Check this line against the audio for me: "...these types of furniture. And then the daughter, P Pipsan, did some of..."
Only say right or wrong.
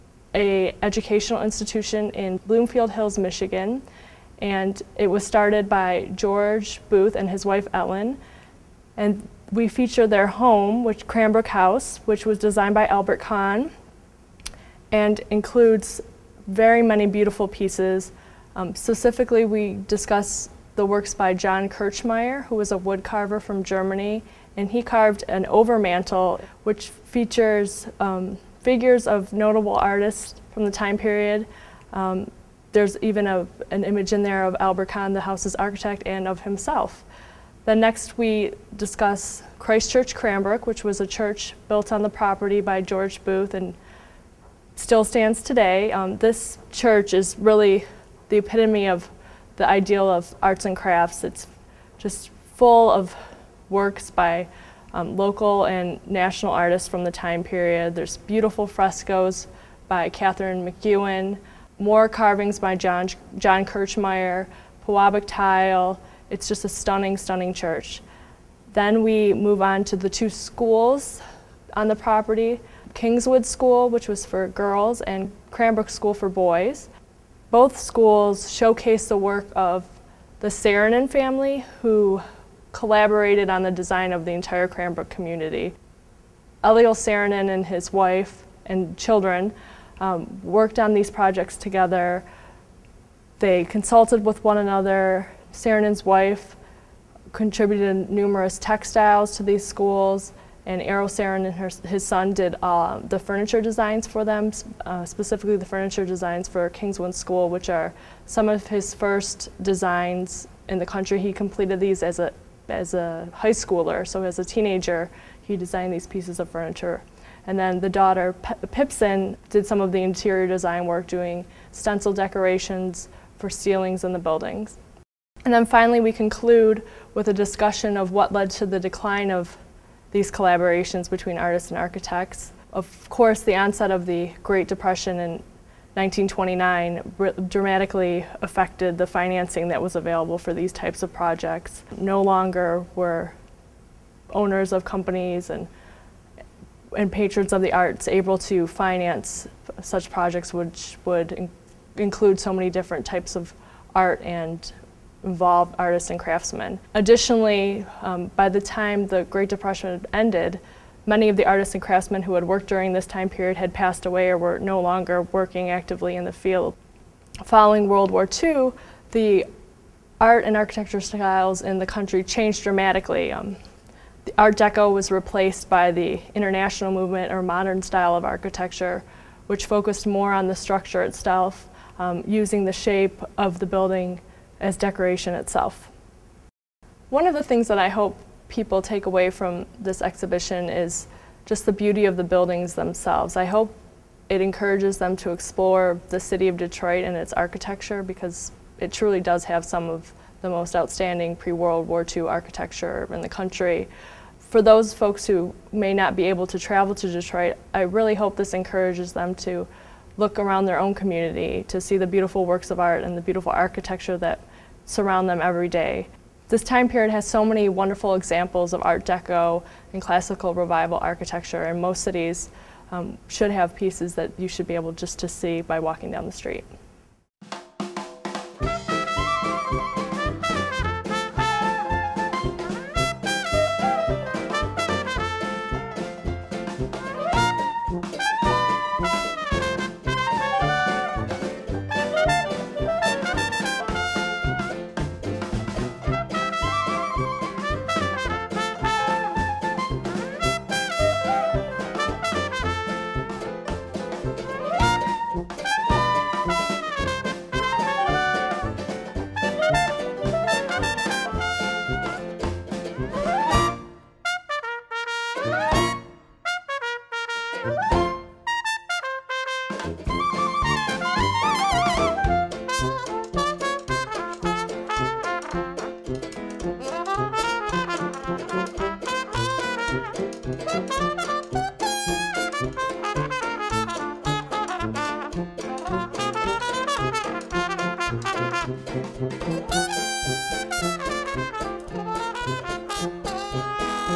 wrong.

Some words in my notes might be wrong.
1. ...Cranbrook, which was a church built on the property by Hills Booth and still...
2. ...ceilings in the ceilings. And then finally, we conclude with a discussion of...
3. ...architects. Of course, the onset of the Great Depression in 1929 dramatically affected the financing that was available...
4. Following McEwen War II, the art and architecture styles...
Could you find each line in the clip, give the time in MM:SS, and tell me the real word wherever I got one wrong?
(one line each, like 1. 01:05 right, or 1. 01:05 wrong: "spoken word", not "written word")
1. 00:40 wrong: "George", not "Hills"
2. 02:03 wrong: "buildings", not "ceilings"
3. 02:11 right
4. 02:47 wrong: "World", not "McEwen".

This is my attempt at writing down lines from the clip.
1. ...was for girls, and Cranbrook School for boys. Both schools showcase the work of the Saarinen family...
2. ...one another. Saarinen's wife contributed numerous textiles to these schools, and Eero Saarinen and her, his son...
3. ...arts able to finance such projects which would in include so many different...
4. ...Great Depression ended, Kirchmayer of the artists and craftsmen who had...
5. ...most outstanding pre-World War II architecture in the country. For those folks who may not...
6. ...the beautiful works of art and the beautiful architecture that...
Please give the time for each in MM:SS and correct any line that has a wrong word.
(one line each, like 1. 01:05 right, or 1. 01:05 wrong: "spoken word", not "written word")
1. 01:14 right
2. 01:34 right
3. 02:27 right
4. 02:39 wrong: "Many", not "Kirchmayer"
5. 03:20 right
6. 03:31 right.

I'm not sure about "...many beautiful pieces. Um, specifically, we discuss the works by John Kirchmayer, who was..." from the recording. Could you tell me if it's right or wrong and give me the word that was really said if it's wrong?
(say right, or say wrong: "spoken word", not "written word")
right.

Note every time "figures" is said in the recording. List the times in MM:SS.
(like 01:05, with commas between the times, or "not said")
00:28.